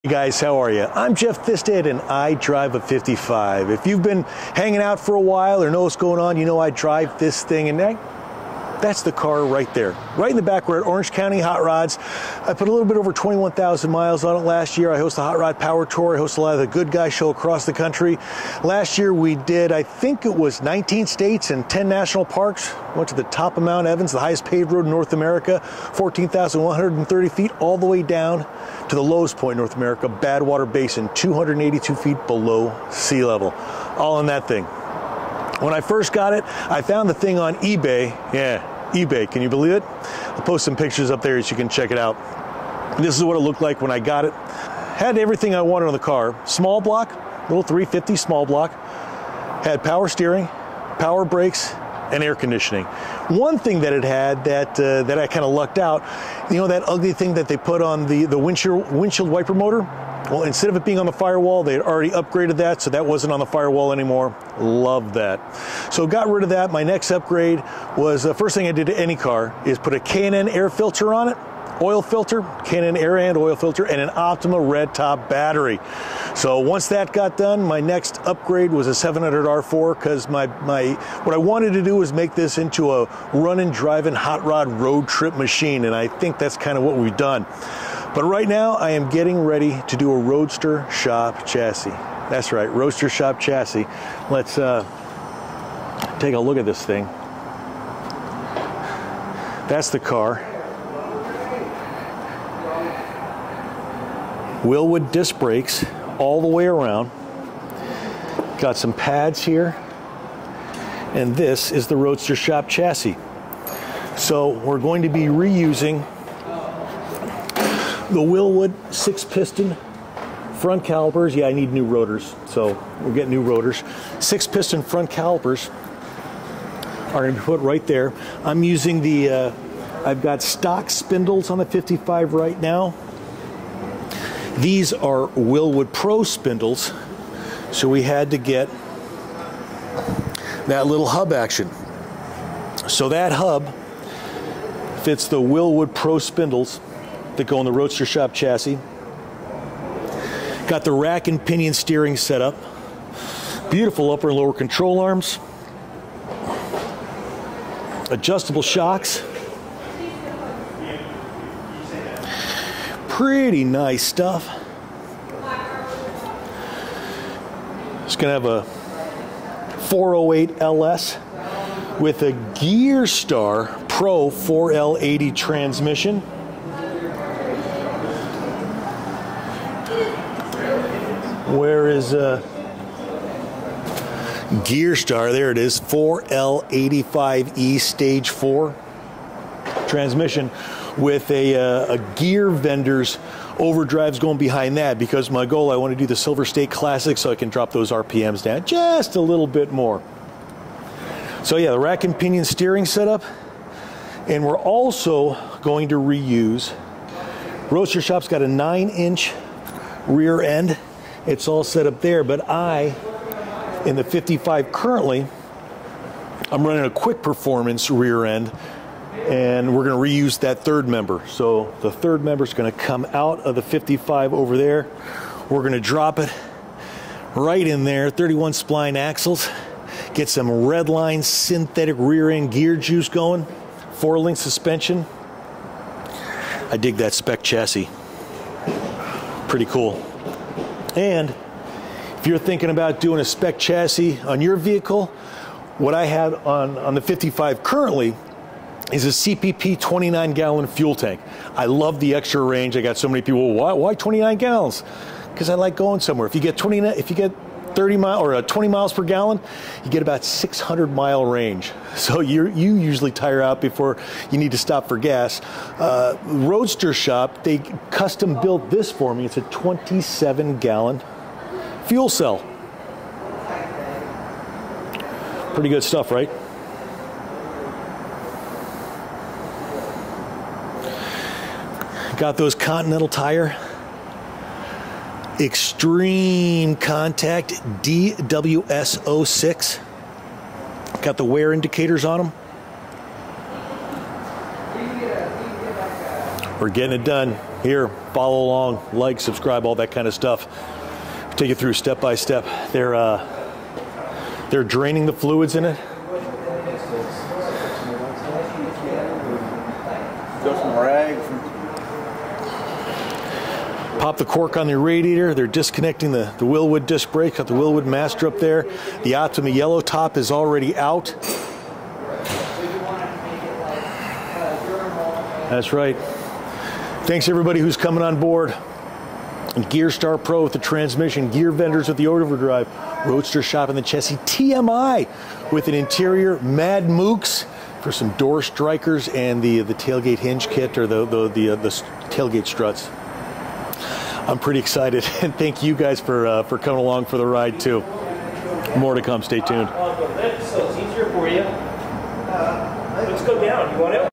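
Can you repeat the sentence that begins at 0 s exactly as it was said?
I'm Jeff Thisted and I drive a 55.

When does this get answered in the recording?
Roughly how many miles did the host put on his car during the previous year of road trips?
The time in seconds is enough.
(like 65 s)
13 s.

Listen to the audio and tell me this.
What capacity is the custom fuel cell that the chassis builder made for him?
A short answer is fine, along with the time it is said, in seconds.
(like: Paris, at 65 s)
27 gallons, at 269 s.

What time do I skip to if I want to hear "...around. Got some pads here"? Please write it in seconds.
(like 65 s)
106 s.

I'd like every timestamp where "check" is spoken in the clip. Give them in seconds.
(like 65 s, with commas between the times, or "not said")
41 s.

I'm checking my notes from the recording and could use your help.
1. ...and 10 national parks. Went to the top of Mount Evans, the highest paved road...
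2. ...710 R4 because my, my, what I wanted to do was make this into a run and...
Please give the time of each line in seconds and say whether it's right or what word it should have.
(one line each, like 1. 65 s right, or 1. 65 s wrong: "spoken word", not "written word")
1. 21 s right
2. 78 s wrong: "700", not "710".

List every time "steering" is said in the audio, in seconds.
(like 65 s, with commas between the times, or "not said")
50 s, 151 s, 202 s.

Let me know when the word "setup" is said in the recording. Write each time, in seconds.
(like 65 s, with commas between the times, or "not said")
202 s.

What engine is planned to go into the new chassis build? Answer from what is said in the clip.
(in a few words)
408 LS.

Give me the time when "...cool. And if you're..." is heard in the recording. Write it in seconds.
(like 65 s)
239 s.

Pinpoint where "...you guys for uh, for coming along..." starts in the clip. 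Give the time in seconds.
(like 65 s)
345 s.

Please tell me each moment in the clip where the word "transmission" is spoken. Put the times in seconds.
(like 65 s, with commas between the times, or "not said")
175 s, 189 s, 330 s.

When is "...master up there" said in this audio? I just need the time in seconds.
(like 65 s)
317 s.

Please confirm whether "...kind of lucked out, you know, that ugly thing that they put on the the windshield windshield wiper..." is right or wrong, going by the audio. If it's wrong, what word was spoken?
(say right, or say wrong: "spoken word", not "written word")
right.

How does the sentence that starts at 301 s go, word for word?
Take you through step by step.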